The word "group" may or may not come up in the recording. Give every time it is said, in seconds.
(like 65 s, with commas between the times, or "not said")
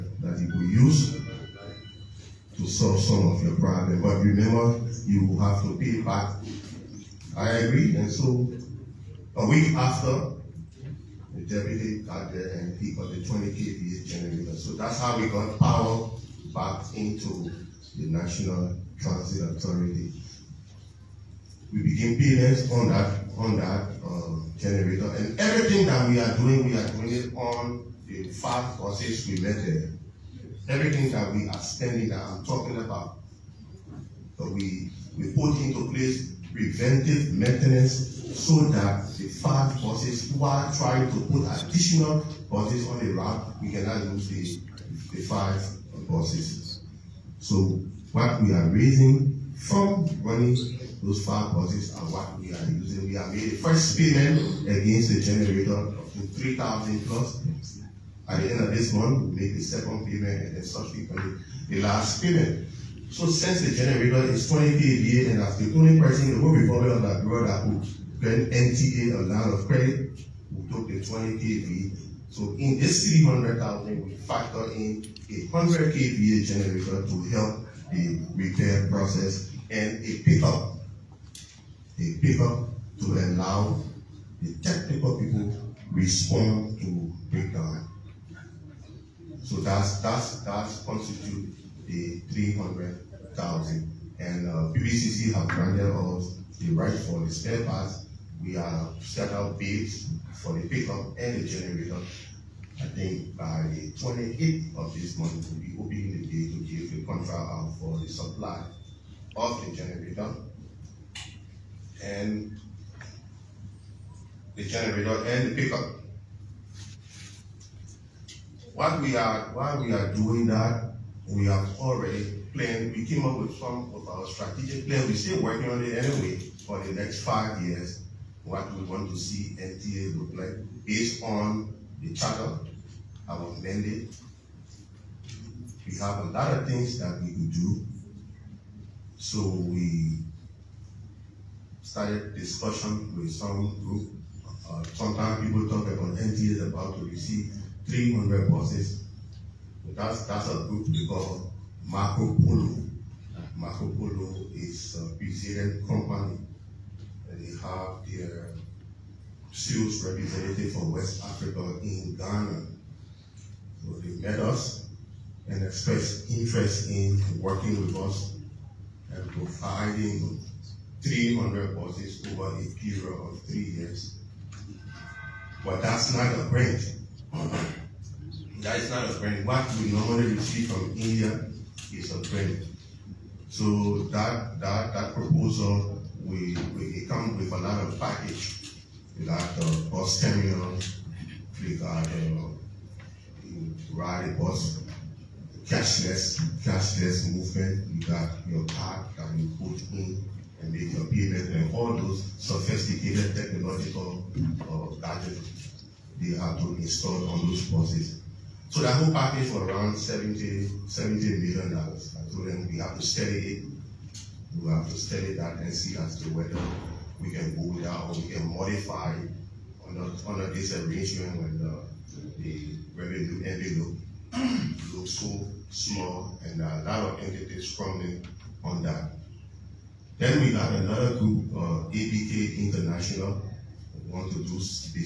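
143 s, 150 s, 231 s.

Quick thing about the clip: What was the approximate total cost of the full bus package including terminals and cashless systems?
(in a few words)
$70 million.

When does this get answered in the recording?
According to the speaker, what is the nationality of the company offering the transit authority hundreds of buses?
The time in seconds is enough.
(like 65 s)
155 s.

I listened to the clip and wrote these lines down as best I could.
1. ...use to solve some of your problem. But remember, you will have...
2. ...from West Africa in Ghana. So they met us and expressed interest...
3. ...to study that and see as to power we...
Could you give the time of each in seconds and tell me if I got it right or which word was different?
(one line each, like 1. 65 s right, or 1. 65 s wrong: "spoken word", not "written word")
1. 0 s right
2. 160 s right
3. 214 s wrong: "whether", not "power".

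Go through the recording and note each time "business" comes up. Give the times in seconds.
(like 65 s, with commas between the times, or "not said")
234 s.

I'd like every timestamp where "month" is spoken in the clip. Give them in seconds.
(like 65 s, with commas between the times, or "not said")
58 s, 105 s.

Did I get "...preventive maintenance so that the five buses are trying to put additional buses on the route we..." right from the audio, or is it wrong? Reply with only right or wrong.
right.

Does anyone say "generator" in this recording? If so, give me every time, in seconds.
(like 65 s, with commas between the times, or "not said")
14 s, 24 s, 55 s, 63 s, 76 s, 101 s, 109 s, 114 s.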